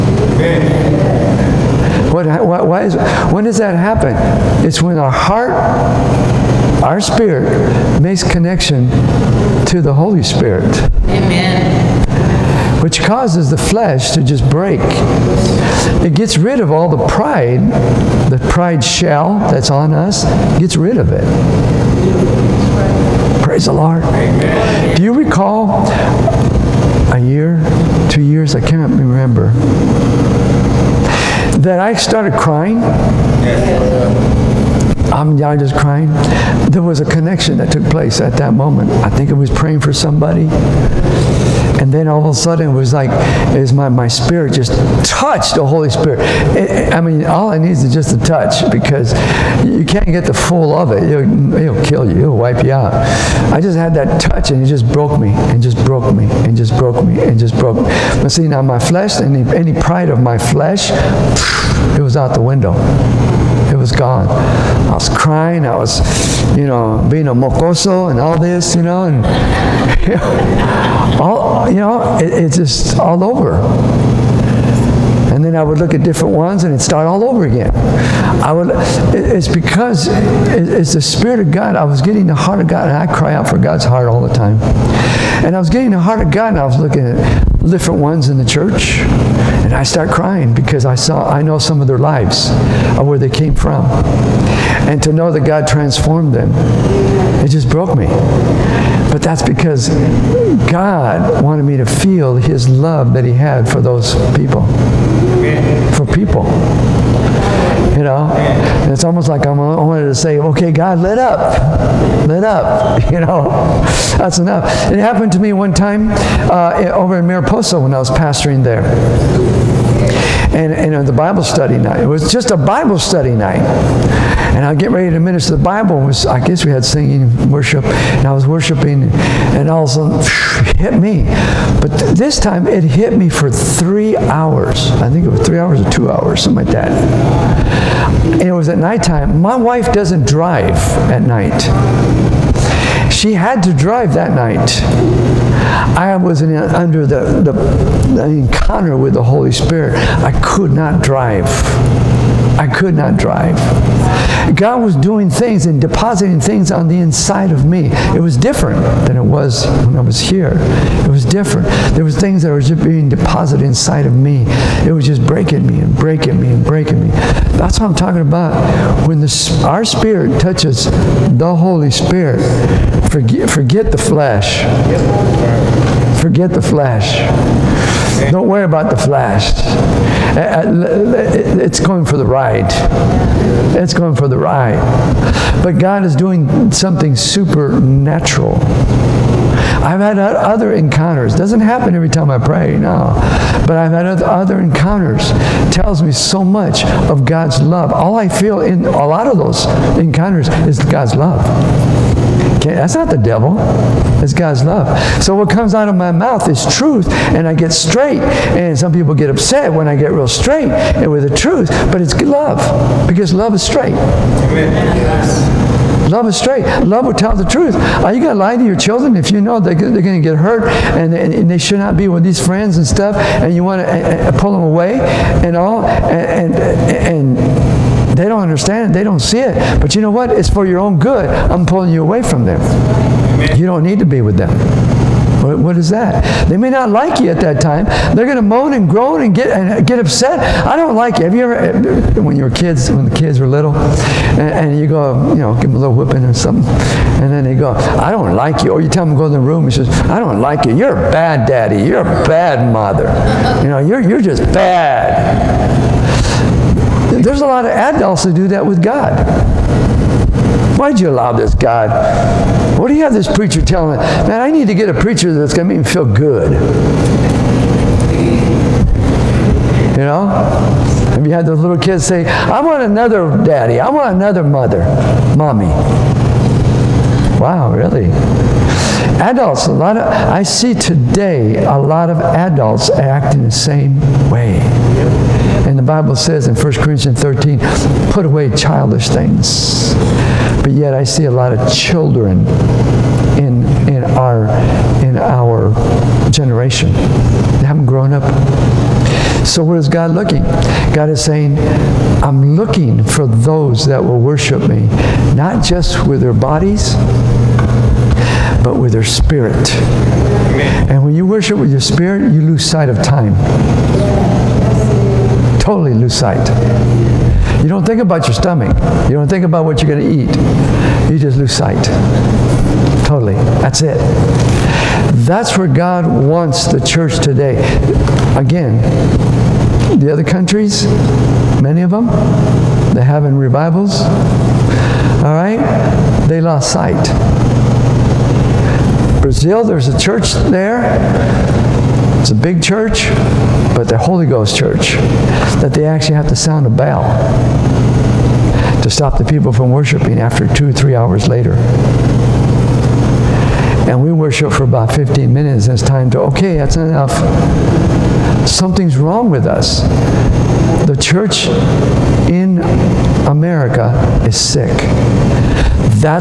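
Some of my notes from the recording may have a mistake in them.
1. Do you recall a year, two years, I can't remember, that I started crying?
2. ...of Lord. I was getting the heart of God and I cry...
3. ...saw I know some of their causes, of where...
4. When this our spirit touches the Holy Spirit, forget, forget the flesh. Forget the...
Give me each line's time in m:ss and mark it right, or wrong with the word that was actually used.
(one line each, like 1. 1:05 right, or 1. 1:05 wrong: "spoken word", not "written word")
1. 0:24 right
2. 1:21 wrong: "God", not "Lord"
3. 1:30 wrong: "lives", not "causes"
4. 2:49 right.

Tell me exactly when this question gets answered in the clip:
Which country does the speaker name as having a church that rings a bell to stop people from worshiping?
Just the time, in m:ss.
5:39.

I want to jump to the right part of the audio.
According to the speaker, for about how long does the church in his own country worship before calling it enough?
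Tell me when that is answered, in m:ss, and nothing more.
5:54.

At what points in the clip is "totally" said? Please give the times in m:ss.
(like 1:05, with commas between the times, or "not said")
5:15, 5:23.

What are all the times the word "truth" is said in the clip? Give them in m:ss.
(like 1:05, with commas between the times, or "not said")
3:26, 3:31, 3:37.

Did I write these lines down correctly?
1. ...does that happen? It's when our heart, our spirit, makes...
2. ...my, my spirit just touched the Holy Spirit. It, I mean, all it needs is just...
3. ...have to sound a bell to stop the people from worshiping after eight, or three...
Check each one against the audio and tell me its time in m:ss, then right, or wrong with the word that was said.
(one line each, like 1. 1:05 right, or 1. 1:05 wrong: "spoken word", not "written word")
1. 0:03 right
2. 0:43 right
3. 5:46 wrong: "two", not "eight".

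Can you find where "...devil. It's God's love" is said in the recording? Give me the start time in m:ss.
3:23.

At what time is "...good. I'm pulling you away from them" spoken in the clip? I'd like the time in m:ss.
3:50.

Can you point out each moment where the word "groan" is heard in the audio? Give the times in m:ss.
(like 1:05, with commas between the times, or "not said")
3:58.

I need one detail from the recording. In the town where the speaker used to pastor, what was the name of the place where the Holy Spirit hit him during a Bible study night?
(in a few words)
Mariposa.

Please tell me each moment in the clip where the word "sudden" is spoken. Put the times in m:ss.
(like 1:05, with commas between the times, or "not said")
0:42, 2:10.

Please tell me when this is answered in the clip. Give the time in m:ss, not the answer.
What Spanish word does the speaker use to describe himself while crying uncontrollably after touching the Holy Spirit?
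1:07.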